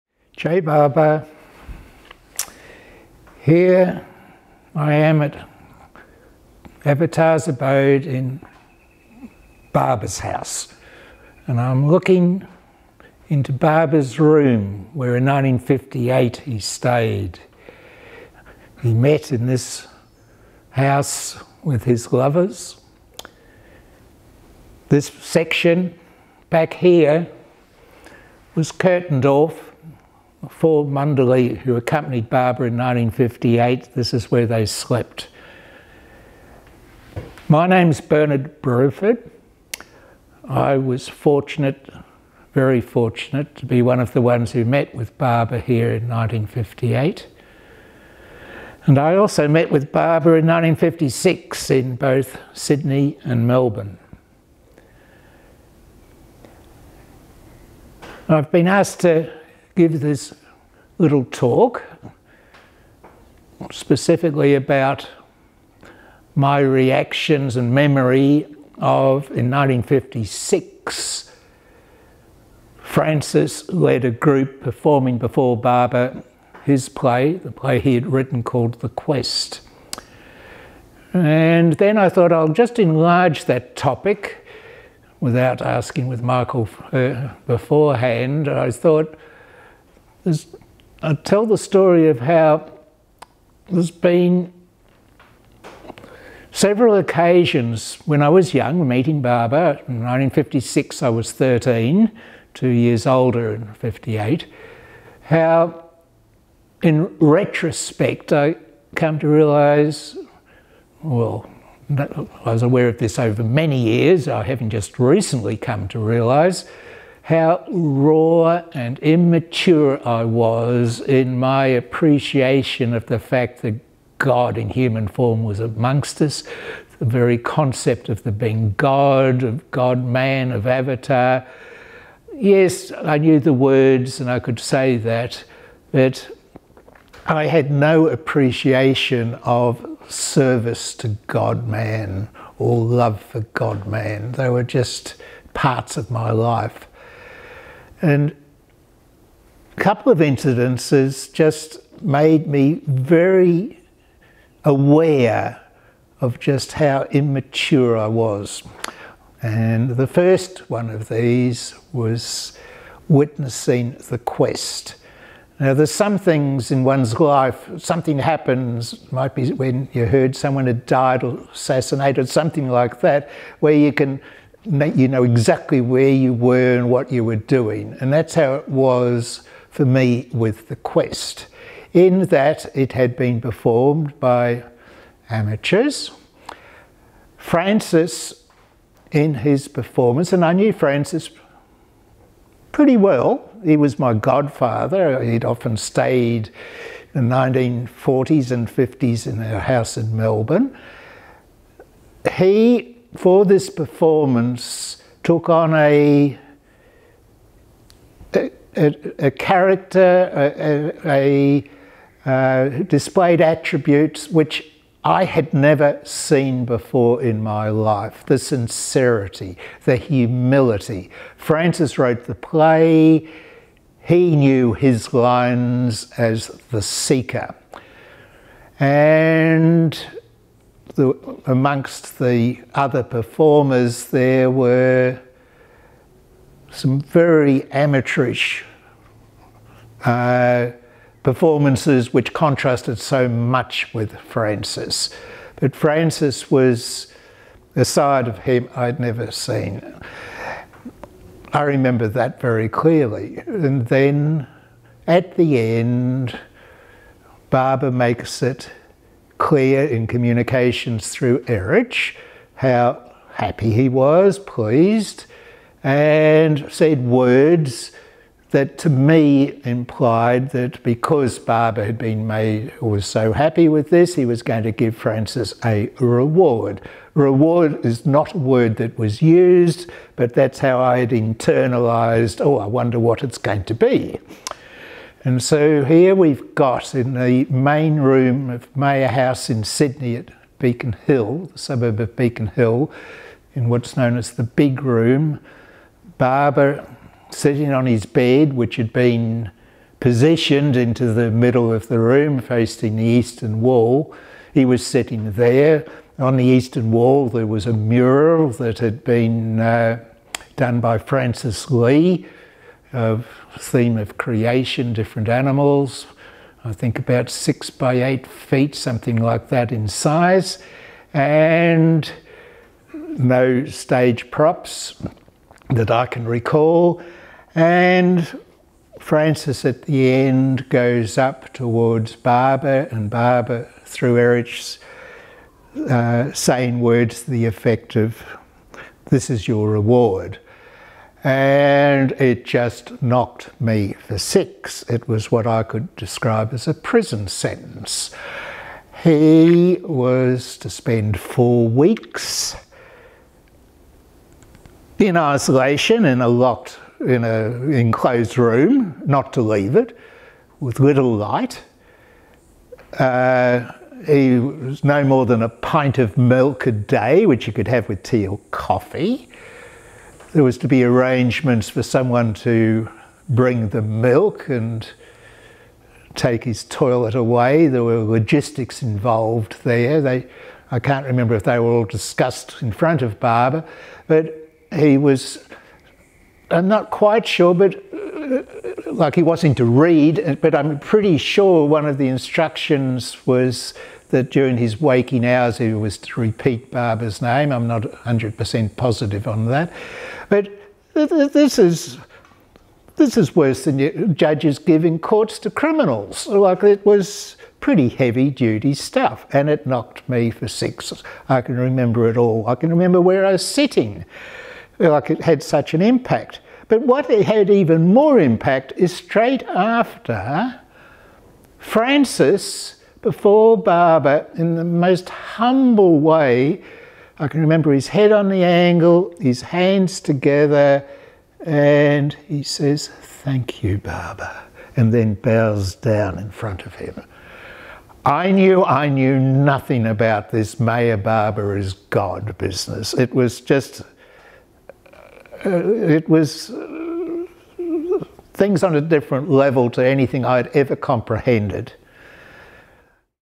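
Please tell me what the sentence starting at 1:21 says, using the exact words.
And then I thought I'll just enlarge that topic without asking with Michael uh, beforehand.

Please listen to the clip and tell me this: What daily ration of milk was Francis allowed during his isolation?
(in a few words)
A pint.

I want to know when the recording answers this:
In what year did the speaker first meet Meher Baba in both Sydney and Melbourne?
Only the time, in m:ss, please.
0:50.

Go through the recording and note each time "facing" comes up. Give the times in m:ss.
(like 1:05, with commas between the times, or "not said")
5:02.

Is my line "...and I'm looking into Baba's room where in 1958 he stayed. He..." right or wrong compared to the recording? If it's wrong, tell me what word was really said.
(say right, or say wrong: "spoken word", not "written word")
right.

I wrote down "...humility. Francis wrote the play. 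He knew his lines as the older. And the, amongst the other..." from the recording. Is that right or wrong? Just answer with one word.
wrong.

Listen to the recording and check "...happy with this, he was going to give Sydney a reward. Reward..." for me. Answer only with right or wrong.
wrong.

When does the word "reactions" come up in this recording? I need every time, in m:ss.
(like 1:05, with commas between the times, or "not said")
1:06.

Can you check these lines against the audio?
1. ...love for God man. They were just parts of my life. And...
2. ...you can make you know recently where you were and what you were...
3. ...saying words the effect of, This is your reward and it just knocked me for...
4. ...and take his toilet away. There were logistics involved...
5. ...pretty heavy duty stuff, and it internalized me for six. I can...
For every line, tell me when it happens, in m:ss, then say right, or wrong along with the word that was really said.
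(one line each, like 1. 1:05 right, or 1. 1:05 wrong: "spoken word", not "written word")
1. 2:22 right
2. 2:53 wrong: "exactly", not "recently"
3. 5:36 right
4. 6:14 right
5. 6:47 wrong: "knocked", not "internalized".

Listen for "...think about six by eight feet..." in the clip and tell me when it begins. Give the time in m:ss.
5:16.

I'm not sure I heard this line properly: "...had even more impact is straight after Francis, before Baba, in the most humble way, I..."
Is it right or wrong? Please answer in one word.
right.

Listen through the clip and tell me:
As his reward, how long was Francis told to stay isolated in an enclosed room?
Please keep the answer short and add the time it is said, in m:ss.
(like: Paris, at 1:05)
4 weeks, at 5:51.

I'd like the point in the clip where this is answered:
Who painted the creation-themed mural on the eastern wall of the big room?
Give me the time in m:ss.
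5:10.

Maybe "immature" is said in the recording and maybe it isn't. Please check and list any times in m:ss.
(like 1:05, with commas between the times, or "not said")
1:58, 2:37.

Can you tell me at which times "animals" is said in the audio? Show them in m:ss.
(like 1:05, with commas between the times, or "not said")
5:15.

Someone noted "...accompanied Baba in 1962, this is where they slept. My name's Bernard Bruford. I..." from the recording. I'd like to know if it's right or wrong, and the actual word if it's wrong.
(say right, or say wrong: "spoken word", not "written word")
wrong: "1958", not "1962".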